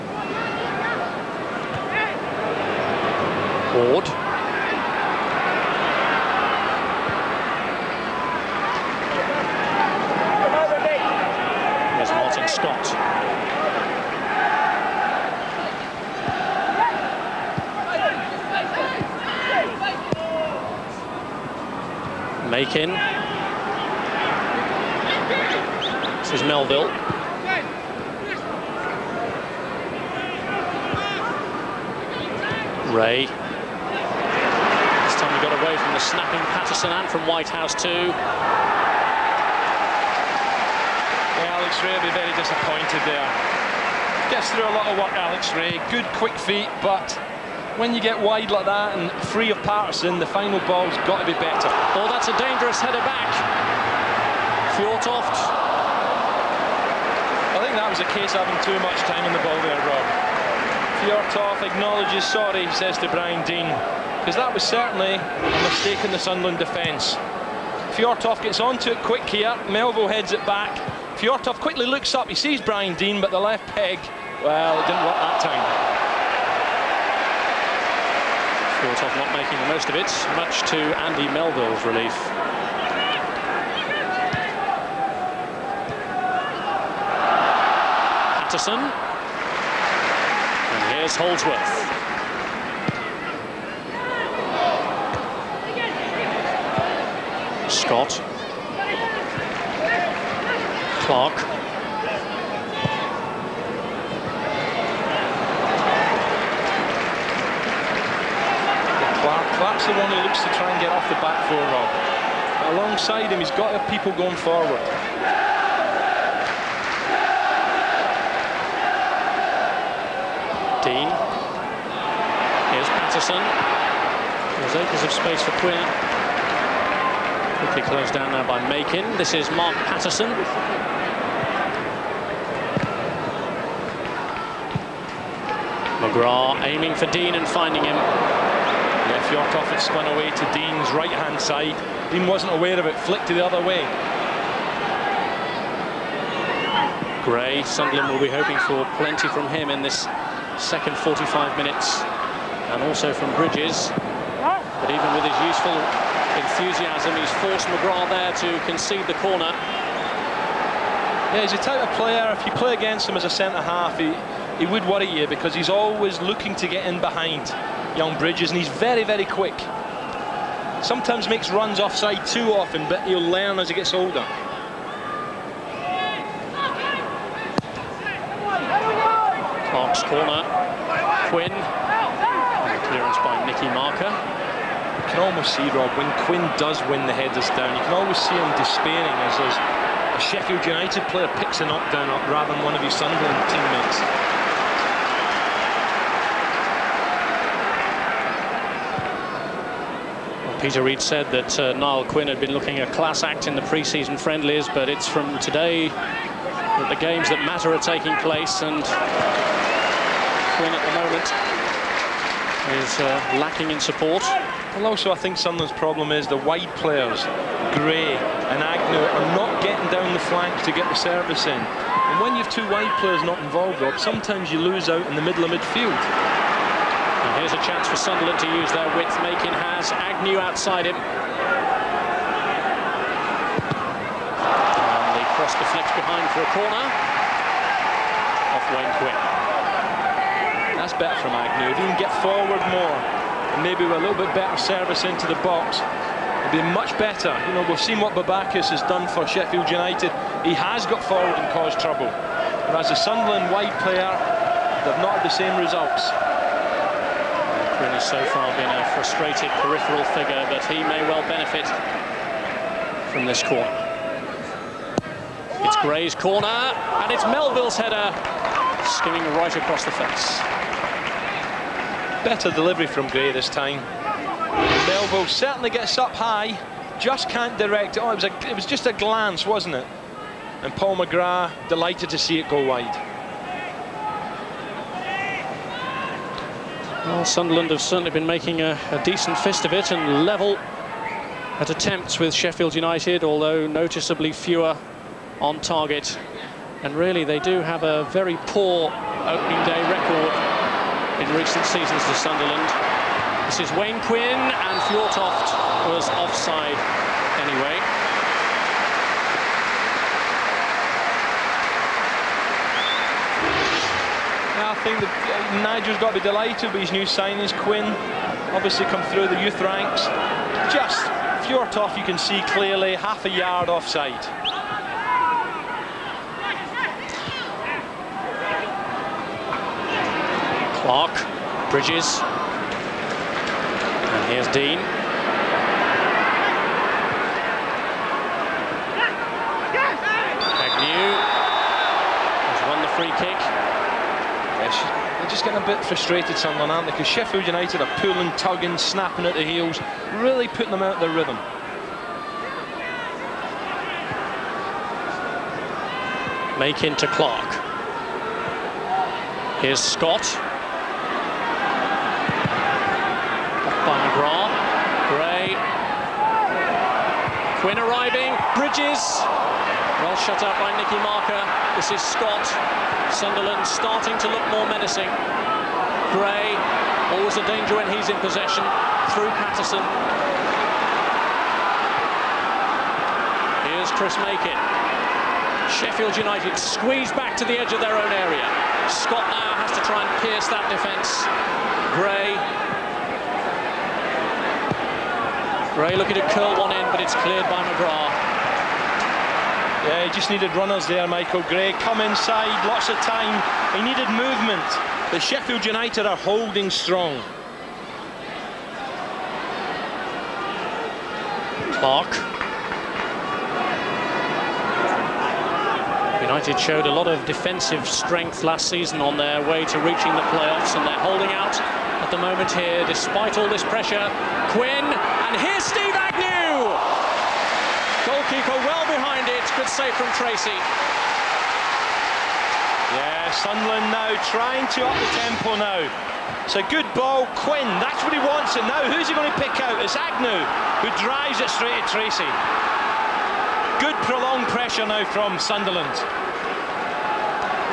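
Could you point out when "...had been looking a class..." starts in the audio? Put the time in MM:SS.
03:22.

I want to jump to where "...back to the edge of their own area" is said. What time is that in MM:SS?
06:27.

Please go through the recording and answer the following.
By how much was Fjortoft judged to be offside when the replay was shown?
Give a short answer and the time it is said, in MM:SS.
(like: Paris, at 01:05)
half a yard, at 05:22.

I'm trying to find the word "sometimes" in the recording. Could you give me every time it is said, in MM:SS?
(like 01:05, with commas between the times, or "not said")
02:50, 03:43.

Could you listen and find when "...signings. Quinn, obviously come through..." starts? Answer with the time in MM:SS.
05:17.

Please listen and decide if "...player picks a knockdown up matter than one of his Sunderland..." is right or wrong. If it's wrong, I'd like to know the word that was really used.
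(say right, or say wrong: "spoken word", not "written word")
wrong: "rather", not "matter".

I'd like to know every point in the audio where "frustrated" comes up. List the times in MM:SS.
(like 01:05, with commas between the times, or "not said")
04:18, 05:45.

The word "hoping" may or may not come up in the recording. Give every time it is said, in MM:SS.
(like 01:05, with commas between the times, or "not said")
02:28.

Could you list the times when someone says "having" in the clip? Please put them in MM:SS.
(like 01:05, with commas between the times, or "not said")
00:58.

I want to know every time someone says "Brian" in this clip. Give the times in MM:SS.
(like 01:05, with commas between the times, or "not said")
01:03, 01:12.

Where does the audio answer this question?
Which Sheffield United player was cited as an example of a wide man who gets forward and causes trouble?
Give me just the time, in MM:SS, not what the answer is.
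04:08.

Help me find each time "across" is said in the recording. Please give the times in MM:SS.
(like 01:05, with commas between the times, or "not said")
04:29.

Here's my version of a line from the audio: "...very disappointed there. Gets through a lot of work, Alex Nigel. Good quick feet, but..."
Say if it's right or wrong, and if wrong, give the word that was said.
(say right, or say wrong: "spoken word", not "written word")
wrong: "Rae", not "Nigel".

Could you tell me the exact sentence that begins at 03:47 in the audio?
Here's a chance for Sunderland to use their width.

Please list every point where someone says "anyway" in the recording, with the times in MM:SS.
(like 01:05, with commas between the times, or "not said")
05:07.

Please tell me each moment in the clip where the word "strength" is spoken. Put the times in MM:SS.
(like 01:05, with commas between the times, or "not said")
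06:57.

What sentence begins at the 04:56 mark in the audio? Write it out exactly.
And really, they do have a very poor opening day record in recent seasons to Sunderland.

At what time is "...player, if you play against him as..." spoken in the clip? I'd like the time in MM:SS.
02:41.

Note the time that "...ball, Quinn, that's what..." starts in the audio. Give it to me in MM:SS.
07:16.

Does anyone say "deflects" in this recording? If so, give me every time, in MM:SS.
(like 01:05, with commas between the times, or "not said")
03:55.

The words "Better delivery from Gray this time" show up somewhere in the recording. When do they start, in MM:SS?
04:32.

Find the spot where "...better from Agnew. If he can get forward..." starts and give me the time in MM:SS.
04:00.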